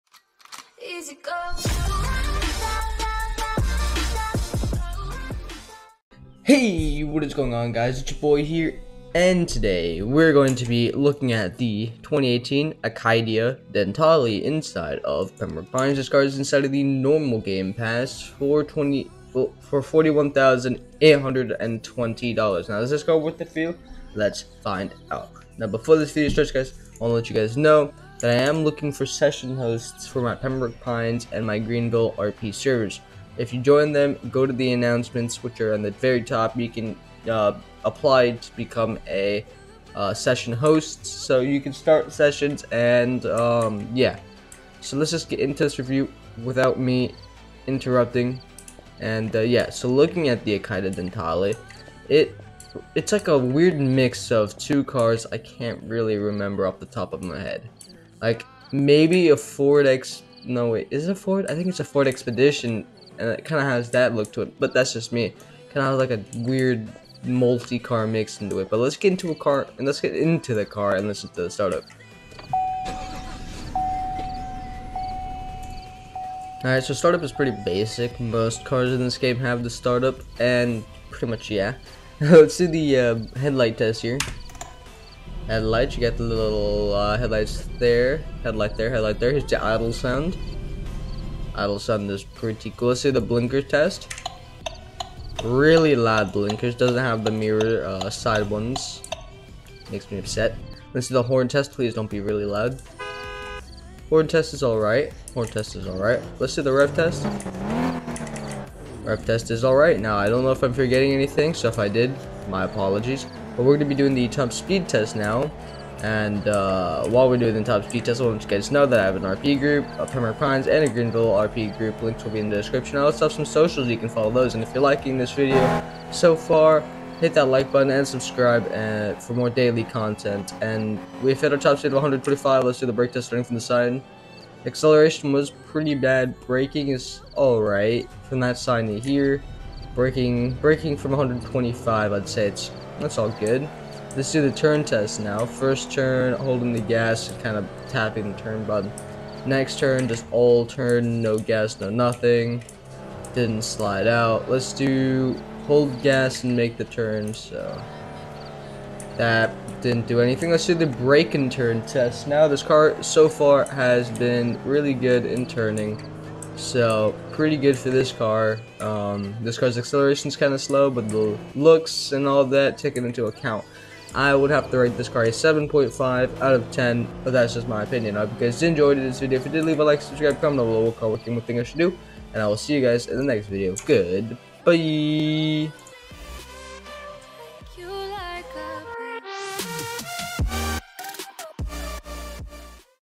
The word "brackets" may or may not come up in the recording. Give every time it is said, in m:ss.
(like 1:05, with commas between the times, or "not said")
not said.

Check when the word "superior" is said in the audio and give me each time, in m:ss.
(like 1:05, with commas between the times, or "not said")
not said.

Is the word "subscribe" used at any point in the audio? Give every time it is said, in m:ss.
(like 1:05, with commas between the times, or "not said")
2:08, 3:00.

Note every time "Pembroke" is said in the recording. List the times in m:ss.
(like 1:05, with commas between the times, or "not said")
0:15, 0:30, 2:00.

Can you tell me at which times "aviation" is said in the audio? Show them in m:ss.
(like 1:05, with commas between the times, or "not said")
not said.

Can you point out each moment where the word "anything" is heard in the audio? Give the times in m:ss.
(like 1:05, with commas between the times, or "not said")
1:51, 2:40.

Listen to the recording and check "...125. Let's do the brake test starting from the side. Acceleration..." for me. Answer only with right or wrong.
right.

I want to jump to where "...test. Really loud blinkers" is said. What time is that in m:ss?
1:33.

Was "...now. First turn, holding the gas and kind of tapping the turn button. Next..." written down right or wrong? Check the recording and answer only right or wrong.
right.